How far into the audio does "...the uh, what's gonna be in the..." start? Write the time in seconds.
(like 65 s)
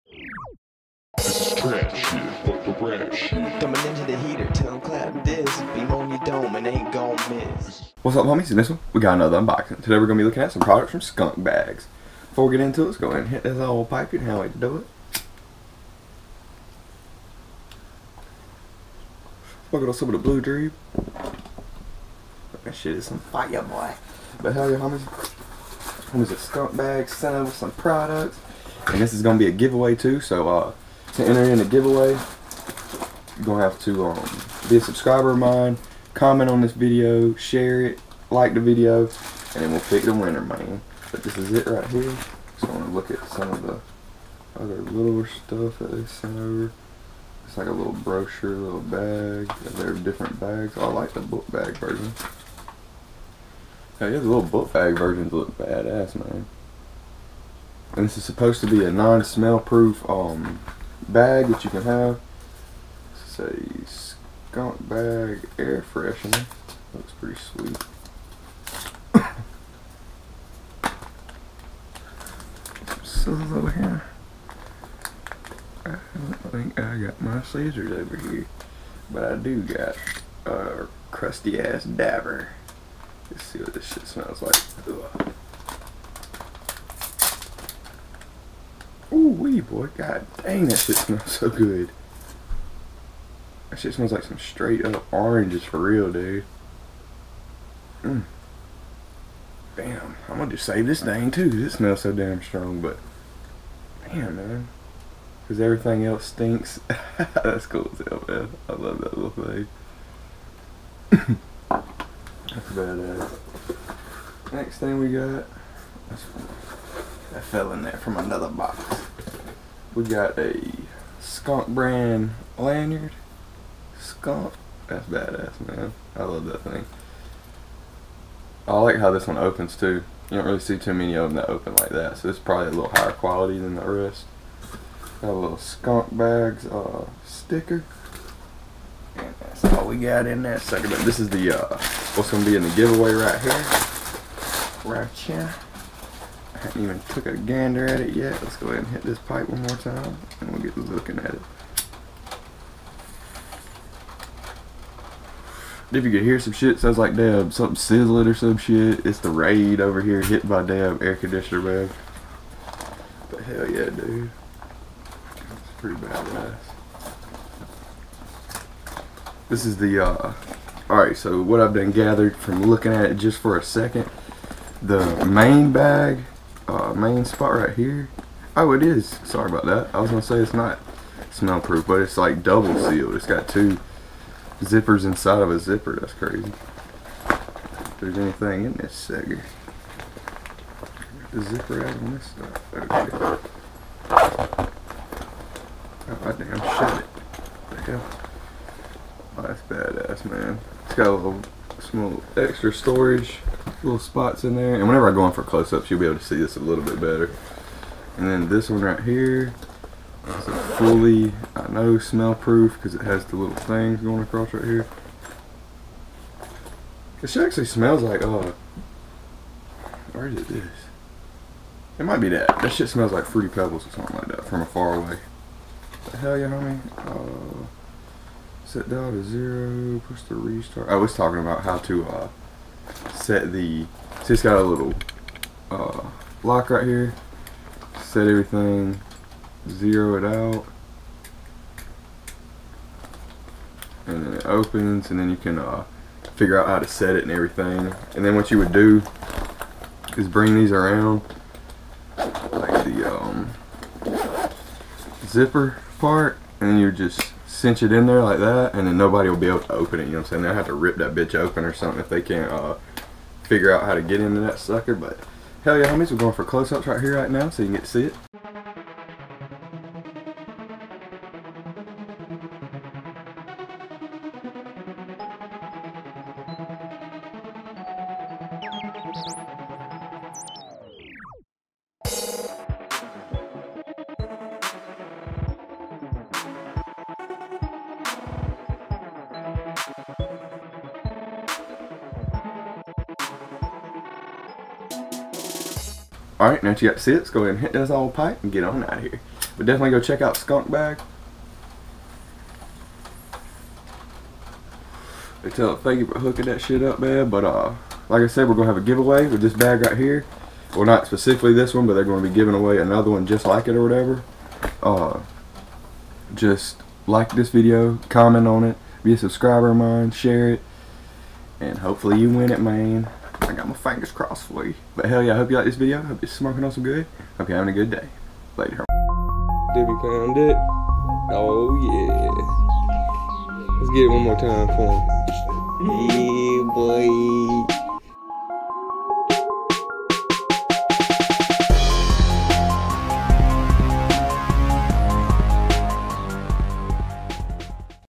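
141 s.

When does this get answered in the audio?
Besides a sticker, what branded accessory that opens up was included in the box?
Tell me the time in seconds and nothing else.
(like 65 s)
122 s.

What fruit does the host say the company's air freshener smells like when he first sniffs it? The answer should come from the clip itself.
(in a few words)
Oranges.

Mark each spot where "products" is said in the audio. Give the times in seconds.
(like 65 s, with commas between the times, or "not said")
10 s, 27 s.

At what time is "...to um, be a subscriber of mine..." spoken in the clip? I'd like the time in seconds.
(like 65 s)
33 s.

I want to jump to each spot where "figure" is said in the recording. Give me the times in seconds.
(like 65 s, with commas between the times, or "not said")
246 s, 263 s.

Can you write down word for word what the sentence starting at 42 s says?
So I'm gonna look at some of the other little stuff that they sent over.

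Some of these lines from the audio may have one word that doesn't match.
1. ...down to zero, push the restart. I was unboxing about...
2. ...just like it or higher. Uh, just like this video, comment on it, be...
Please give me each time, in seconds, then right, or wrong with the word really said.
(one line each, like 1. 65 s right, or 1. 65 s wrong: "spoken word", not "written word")
1. 228 s wrong: "talking", not "unboxing"
2. 313 s wrong: "whatever", not "higher".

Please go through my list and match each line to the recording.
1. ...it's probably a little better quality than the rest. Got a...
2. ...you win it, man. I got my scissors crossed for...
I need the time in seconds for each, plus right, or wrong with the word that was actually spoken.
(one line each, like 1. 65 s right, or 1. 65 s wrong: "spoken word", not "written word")
1. 132 s wrong: "higher", not "better"
2. 322 s wrong: "fingers", not "scissors".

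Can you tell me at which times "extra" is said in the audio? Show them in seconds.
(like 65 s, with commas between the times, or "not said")
202 s.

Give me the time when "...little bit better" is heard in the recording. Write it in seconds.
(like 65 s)
206 s.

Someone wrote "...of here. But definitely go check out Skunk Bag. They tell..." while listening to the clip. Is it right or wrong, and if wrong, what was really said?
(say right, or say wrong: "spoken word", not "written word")
right.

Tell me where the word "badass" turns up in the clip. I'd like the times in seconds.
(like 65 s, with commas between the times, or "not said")
55 s, 112 s, 125 s, 165 s, 199 s.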